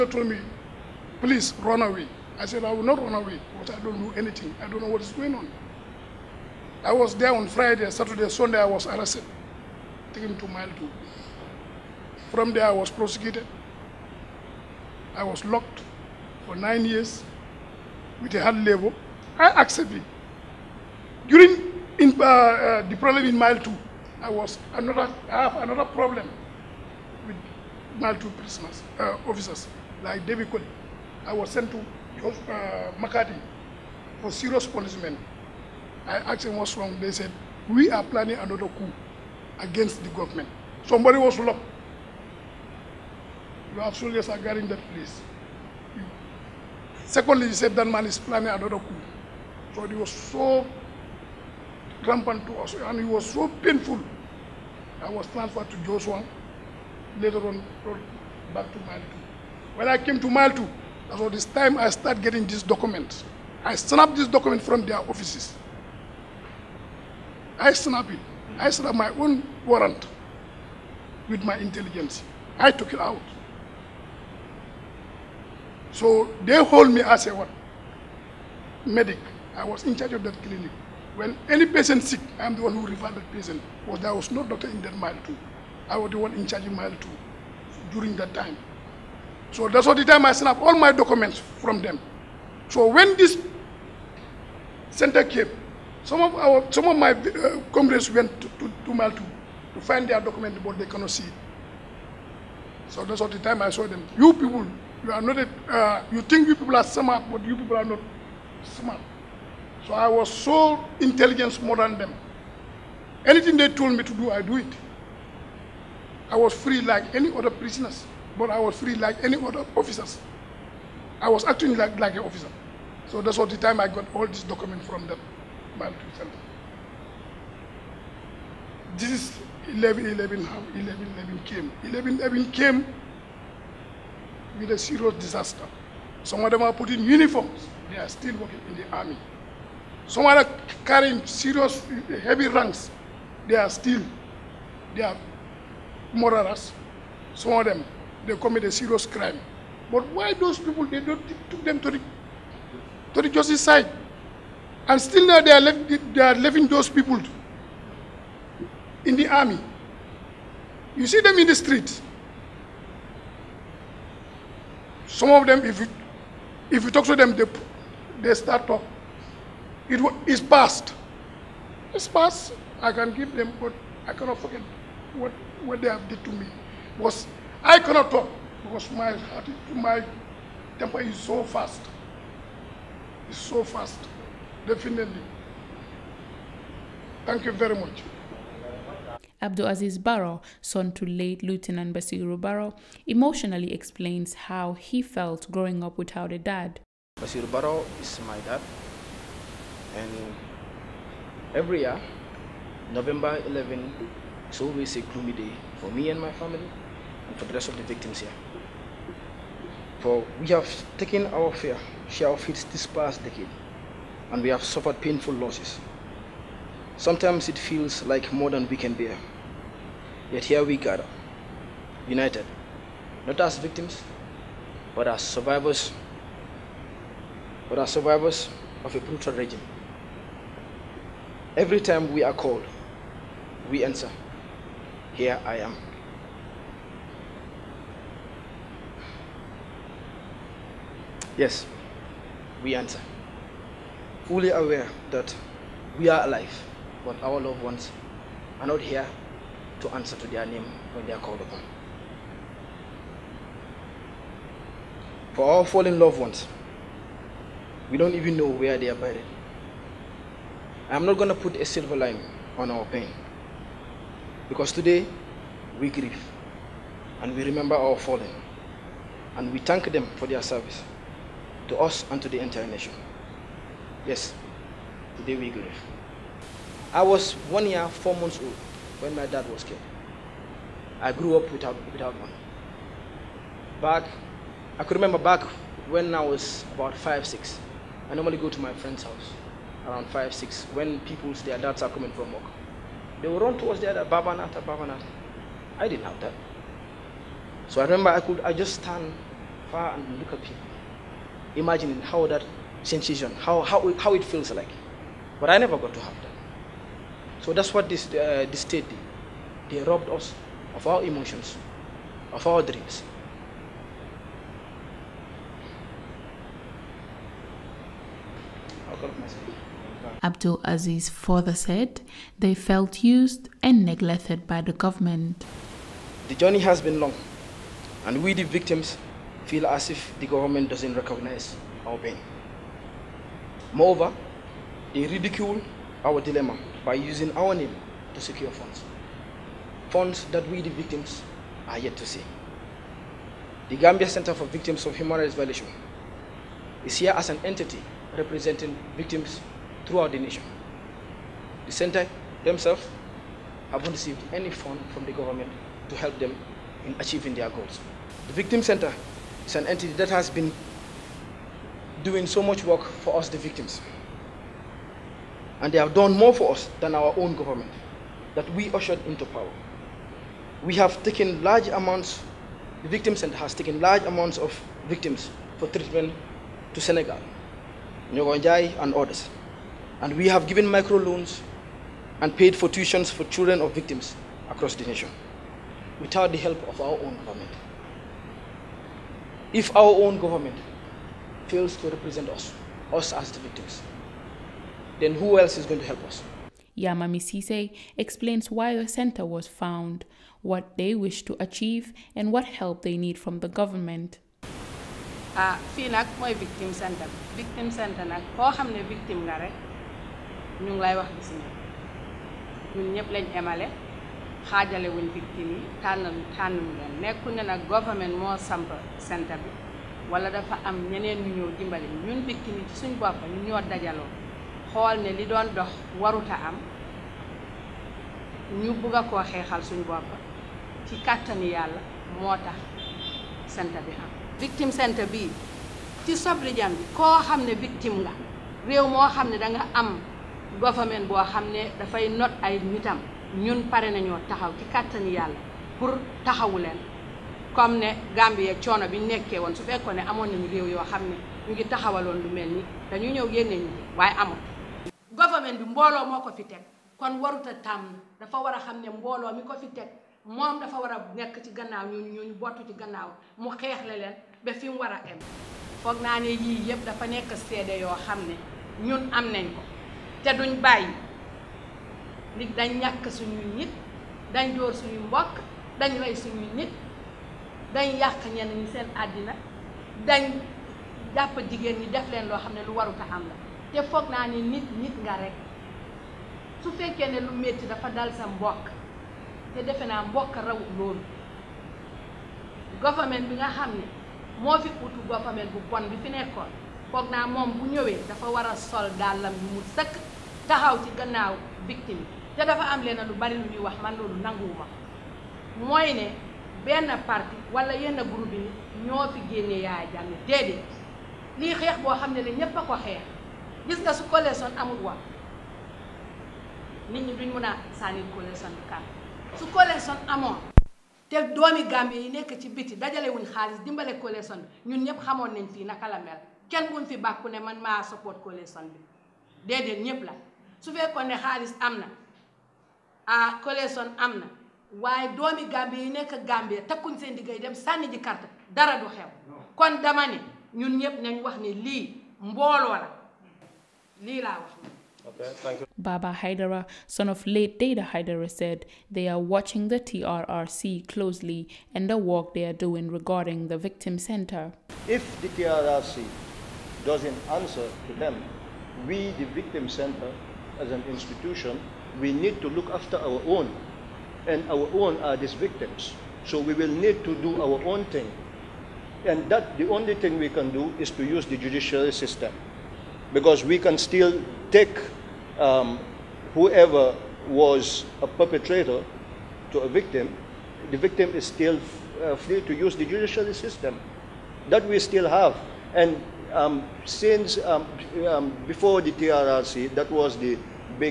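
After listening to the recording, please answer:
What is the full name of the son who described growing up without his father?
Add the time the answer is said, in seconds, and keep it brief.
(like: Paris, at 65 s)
Abdul Aziz Barrow, at 189 s.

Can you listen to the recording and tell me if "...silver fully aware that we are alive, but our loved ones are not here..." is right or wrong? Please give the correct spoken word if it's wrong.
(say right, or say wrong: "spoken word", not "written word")
wrong: "answer", not "silver".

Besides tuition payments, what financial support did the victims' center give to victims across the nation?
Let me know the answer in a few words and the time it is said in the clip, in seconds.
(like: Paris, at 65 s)
Microloans, at 380 s.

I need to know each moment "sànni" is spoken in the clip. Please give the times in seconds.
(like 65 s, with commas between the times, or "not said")
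517 s, 537 s.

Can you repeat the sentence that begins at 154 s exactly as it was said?
And still now they are, left, they are leaving those people in the army.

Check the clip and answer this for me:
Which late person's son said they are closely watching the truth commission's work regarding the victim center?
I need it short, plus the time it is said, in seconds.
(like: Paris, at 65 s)
Deyda Hydara, at 547 s.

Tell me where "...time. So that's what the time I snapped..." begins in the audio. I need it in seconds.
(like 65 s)
88 s.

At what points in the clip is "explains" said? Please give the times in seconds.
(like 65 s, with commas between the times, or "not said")
193 s, 397 s.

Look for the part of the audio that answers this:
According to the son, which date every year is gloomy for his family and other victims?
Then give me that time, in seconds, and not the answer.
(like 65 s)
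202 s.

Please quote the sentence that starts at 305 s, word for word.
But I never got to have that.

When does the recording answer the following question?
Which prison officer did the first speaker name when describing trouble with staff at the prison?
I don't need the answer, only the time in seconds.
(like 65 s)
30 s.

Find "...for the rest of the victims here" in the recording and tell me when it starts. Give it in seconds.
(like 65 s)
207 s.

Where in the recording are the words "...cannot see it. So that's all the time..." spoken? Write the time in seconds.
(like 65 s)
100 s.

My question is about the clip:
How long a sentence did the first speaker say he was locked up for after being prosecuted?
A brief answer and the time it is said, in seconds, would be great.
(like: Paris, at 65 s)
9 years, at 16 s.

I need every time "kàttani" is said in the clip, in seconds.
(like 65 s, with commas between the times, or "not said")
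431 s, 444 s.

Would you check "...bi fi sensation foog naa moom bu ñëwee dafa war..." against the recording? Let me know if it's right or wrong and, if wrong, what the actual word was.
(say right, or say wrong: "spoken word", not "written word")
wrong: "nekkoon", not "sensation".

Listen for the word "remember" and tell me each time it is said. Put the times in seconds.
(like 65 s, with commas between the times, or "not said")
267 s, 284 s, 297 s.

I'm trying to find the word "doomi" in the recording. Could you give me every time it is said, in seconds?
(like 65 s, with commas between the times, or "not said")
521 s, 535 s.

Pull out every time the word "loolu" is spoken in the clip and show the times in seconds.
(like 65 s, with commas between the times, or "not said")
490 s, 503 s.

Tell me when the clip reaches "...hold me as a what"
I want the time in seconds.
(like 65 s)
76 s.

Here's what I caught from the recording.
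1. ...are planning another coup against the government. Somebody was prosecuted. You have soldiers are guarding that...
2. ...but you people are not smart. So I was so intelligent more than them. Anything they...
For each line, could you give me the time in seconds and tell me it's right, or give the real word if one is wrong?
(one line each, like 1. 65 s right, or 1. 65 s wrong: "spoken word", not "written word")
1. 37 s wrong: "locked", not "prosecuted"
2. 107 s right.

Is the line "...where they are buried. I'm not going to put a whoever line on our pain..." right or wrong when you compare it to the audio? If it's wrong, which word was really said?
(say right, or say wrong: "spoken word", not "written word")
wrong: "silver", not "whoever".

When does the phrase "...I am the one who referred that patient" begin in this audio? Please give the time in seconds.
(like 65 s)
82 s.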